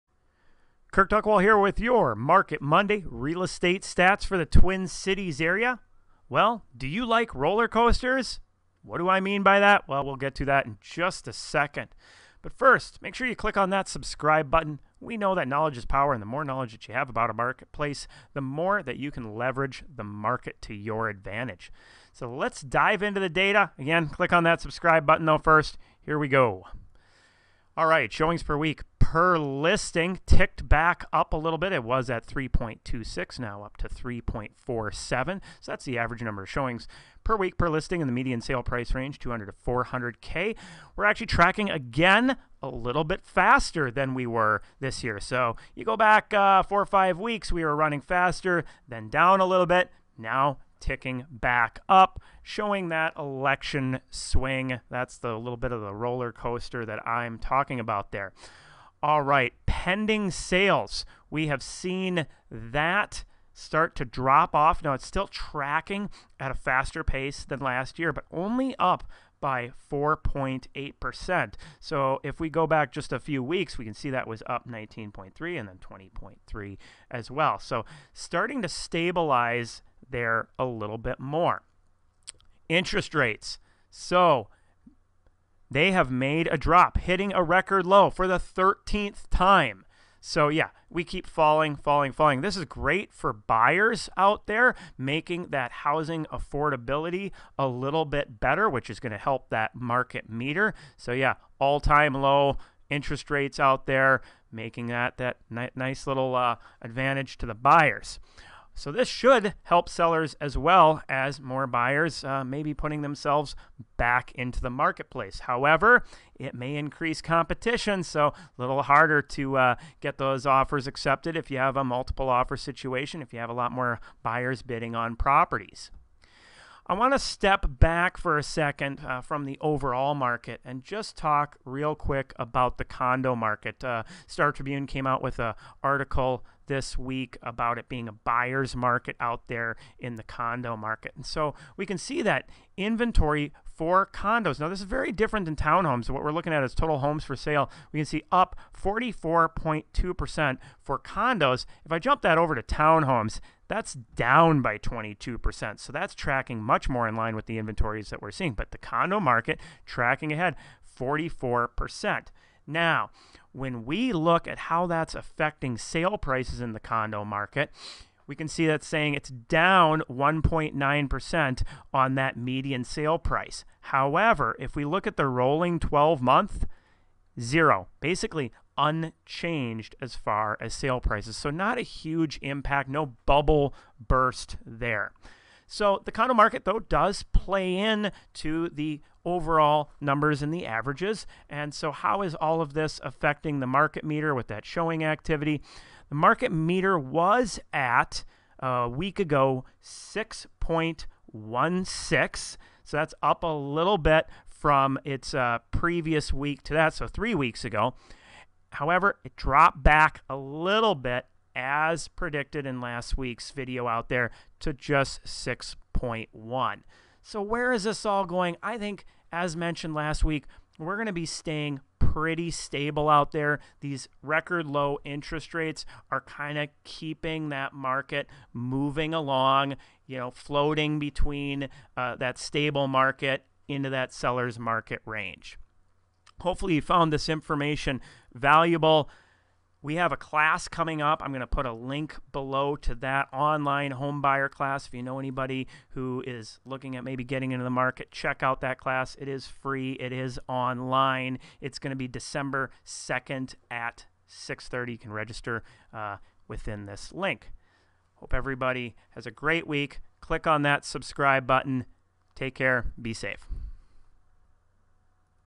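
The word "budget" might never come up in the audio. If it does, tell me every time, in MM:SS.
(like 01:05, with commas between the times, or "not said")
not said.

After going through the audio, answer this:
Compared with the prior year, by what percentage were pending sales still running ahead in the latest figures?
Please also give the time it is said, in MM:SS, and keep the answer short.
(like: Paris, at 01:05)
4.8%, at 01:09.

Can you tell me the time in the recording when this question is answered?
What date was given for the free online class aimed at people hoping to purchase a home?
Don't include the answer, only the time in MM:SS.
04:12.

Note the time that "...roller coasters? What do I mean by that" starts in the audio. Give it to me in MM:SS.
00:07.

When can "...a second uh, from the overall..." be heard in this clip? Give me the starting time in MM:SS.
02:08.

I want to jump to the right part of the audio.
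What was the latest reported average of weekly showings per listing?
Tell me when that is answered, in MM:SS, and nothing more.
00:33.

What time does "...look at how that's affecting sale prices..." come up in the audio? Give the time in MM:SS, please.
02:44.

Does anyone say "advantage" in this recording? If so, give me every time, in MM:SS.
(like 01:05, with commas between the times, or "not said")
00:21, 01:46.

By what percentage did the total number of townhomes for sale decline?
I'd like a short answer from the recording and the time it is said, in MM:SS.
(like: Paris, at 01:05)
22%, at 02:33.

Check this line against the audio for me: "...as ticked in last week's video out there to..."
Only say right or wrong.
wrong.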